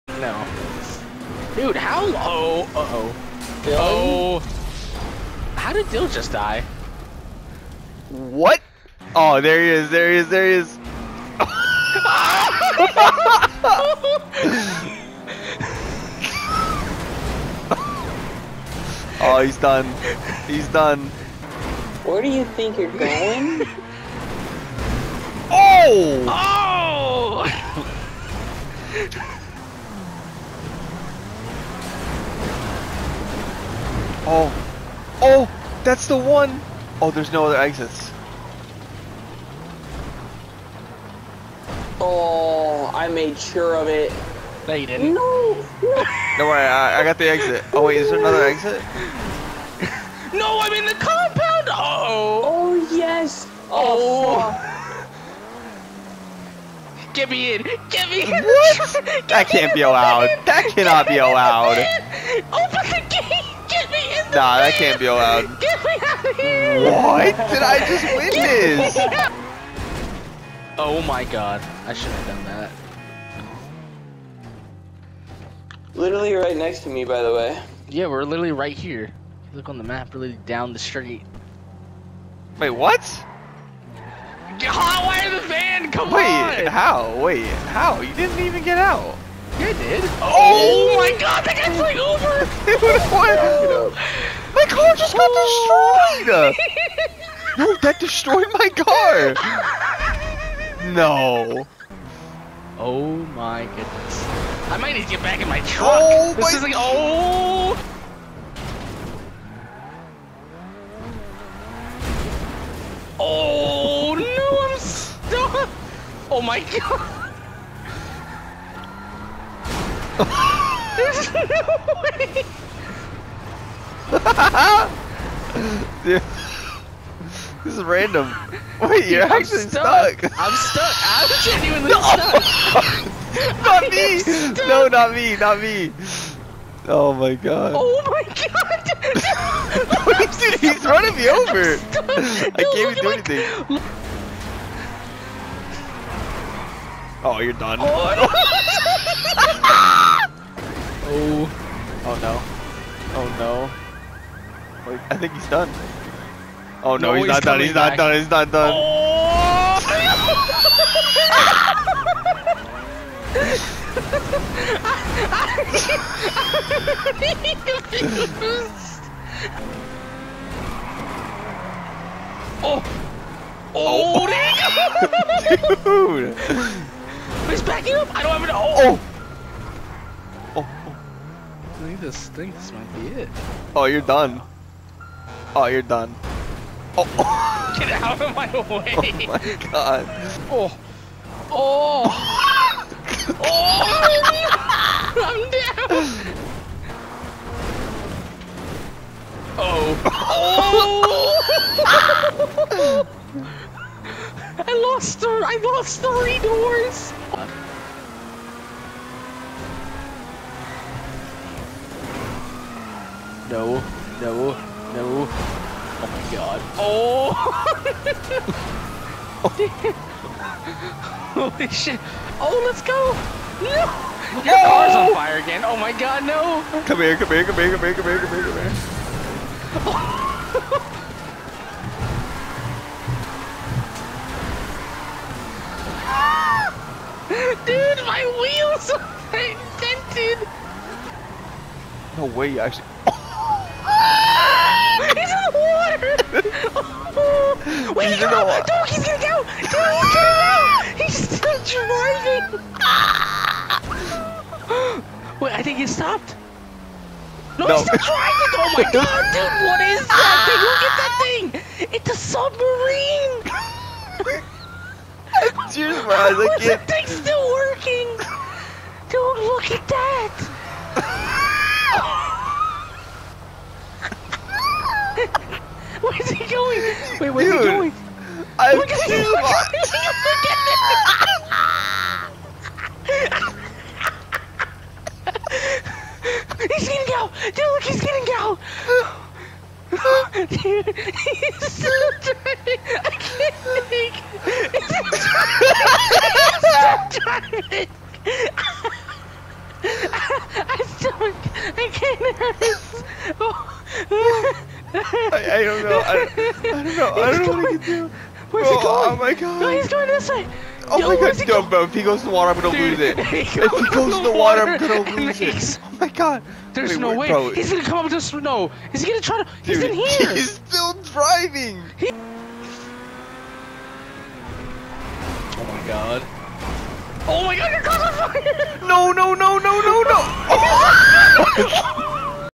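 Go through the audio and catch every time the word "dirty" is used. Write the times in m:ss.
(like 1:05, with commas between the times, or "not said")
4:52, 4:57.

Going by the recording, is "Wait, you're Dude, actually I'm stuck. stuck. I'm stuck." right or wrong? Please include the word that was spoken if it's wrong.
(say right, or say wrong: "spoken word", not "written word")
right.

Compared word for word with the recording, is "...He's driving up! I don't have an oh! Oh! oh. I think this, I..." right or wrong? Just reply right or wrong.
wrong.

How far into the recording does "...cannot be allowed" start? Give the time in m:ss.
1:00.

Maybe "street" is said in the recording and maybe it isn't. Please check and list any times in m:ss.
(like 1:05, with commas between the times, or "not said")
1:20.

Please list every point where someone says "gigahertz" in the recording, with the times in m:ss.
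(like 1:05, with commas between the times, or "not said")
not said.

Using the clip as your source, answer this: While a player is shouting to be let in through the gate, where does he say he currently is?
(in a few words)
the compound.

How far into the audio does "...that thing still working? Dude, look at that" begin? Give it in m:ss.
4:26.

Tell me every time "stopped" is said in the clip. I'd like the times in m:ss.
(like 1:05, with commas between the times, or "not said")
4:15.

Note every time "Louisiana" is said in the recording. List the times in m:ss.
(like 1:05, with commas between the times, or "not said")
not said.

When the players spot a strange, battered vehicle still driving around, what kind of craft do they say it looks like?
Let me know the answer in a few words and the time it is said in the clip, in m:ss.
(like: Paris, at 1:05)
submarine, at 4:22.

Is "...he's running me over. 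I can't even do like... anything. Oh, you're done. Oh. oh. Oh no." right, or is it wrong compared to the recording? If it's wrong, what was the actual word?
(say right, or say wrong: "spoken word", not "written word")
right.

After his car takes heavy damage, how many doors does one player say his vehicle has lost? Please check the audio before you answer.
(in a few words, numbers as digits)
3.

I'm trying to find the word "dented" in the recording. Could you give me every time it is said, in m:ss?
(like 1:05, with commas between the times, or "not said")
3:59.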